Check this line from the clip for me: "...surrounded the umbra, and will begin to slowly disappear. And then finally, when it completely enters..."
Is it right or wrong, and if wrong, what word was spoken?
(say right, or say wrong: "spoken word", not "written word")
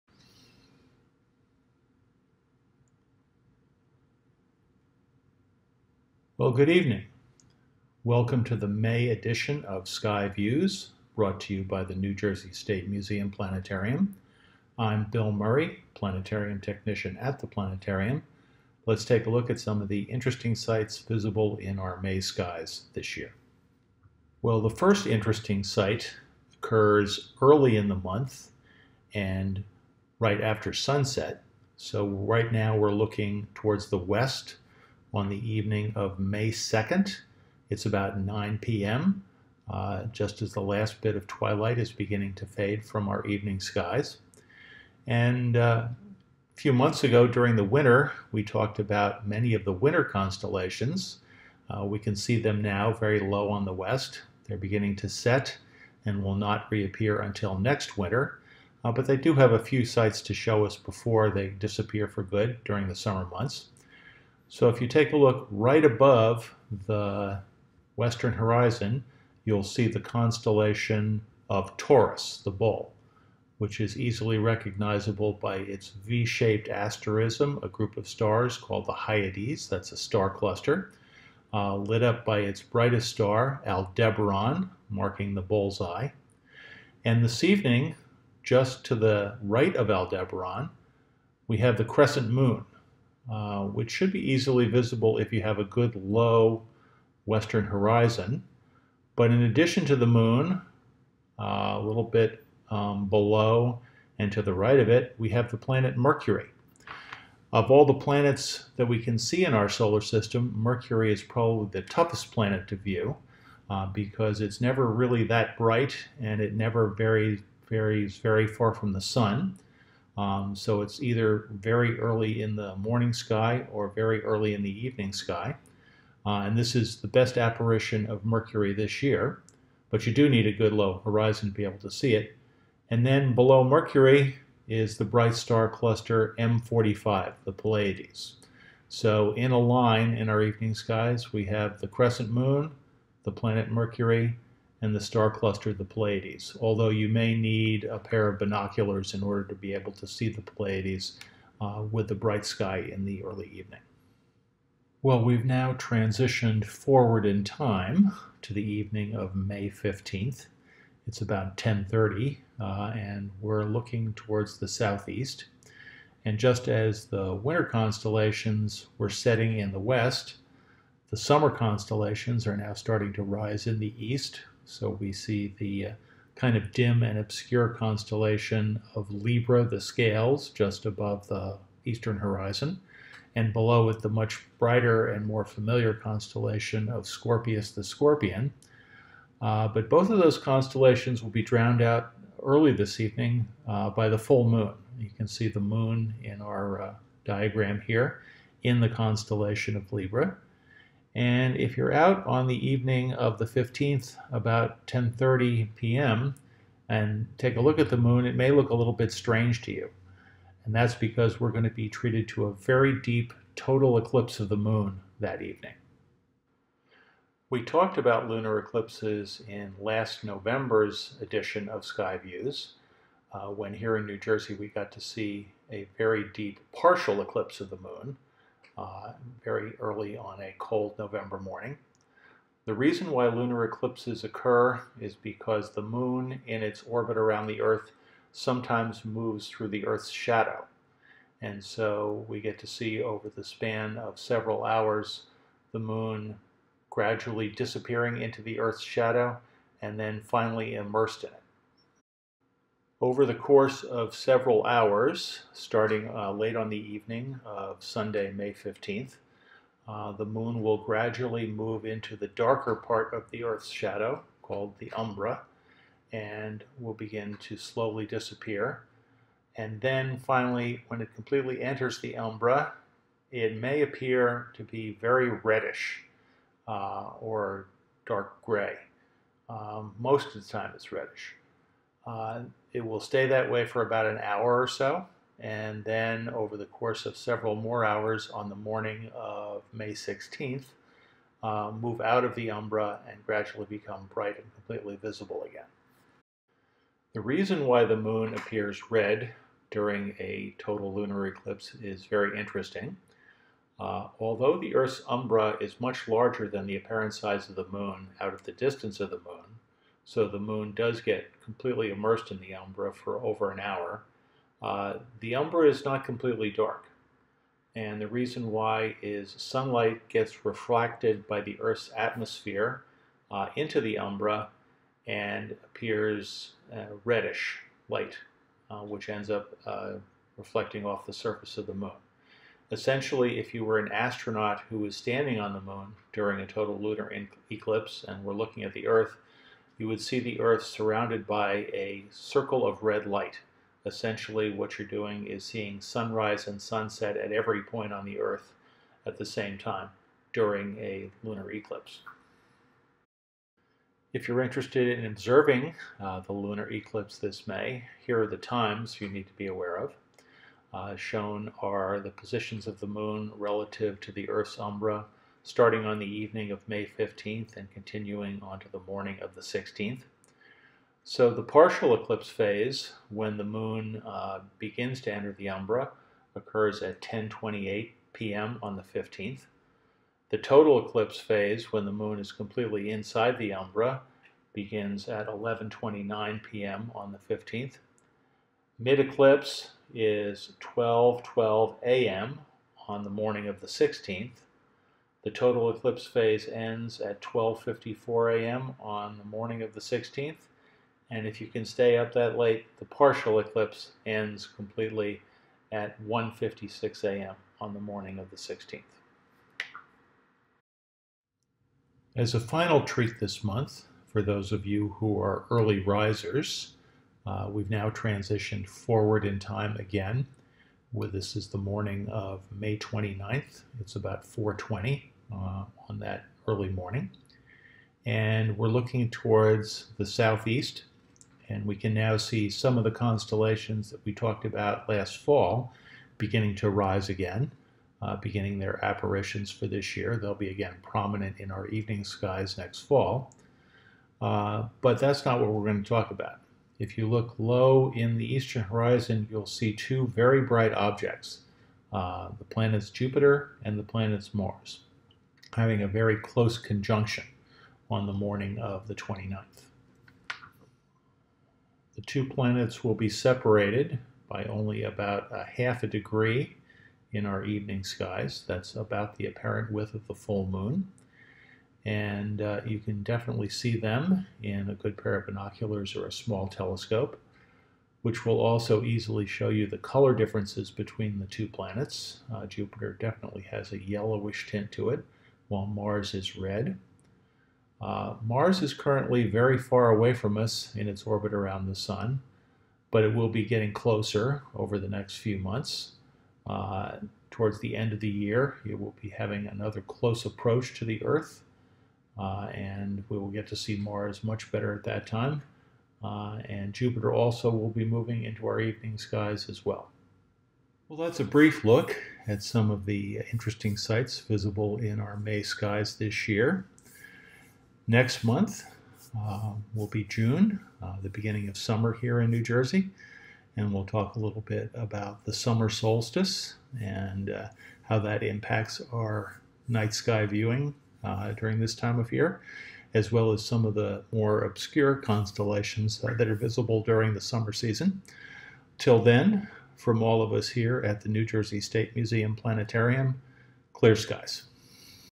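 wrong: "called", not "surrounded".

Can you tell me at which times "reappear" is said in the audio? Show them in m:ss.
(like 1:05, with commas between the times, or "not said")
0:56.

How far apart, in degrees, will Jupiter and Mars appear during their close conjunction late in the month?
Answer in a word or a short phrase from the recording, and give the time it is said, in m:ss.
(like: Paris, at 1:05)
half a degree, at 7:45.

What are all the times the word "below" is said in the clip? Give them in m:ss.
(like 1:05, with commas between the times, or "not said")
1:43, 2:13, 3:03.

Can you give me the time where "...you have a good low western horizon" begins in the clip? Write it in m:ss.
1:35.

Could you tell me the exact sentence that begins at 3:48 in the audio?
Uh, very early on a cold November morning.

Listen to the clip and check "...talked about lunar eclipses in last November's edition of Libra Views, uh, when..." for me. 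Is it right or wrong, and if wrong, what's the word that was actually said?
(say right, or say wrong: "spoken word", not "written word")
wrong: "Sky", not "Libra".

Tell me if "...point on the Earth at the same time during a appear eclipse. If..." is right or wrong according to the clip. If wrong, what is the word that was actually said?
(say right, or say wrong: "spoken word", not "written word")
wrong: "lunar", not "appear".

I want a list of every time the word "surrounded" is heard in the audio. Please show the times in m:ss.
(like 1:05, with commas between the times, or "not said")
5:40.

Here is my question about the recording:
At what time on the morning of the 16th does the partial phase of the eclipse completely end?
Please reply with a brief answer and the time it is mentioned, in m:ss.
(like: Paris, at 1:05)
1:56 a.m., at 6:46.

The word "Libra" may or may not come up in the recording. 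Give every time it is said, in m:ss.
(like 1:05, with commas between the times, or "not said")
2:59, 3:19.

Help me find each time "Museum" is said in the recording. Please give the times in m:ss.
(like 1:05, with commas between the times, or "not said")
0:12, 9:01.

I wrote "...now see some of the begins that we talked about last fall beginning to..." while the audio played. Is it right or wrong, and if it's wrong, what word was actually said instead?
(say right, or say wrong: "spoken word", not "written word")
wrong: "constellations", not "begins".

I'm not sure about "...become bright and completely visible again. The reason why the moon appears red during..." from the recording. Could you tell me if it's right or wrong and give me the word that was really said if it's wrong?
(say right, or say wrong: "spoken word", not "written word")
right.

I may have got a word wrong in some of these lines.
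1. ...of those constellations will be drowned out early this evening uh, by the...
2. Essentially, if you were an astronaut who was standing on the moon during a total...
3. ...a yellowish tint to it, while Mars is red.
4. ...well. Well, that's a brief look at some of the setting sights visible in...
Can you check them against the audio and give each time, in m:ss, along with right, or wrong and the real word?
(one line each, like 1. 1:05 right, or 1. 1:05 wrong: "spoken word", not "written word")
1. 3:10 right
2. 5:32 right
3. 8:03 right
4. 8:29 wrong: "interesting", not "setting".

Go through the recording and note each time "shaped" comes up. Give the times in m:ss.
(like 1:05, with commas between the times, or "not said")
1:16.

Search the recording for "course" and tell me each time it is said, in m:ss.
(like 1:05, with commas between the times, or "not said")
4:13, 4:46.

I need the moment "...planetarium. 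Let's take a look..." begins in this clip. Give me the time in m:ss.
0:17.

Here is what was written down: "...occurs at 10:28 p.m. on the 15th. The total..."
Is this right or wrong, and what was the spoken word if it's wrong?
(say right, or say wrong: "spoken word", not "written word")
right.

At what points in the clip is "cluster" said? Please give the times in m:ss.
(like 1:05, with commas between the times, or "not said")
1:20, 2:15, 2:25.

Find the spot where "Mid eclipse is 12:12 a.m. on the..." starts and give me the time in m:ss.
6:28.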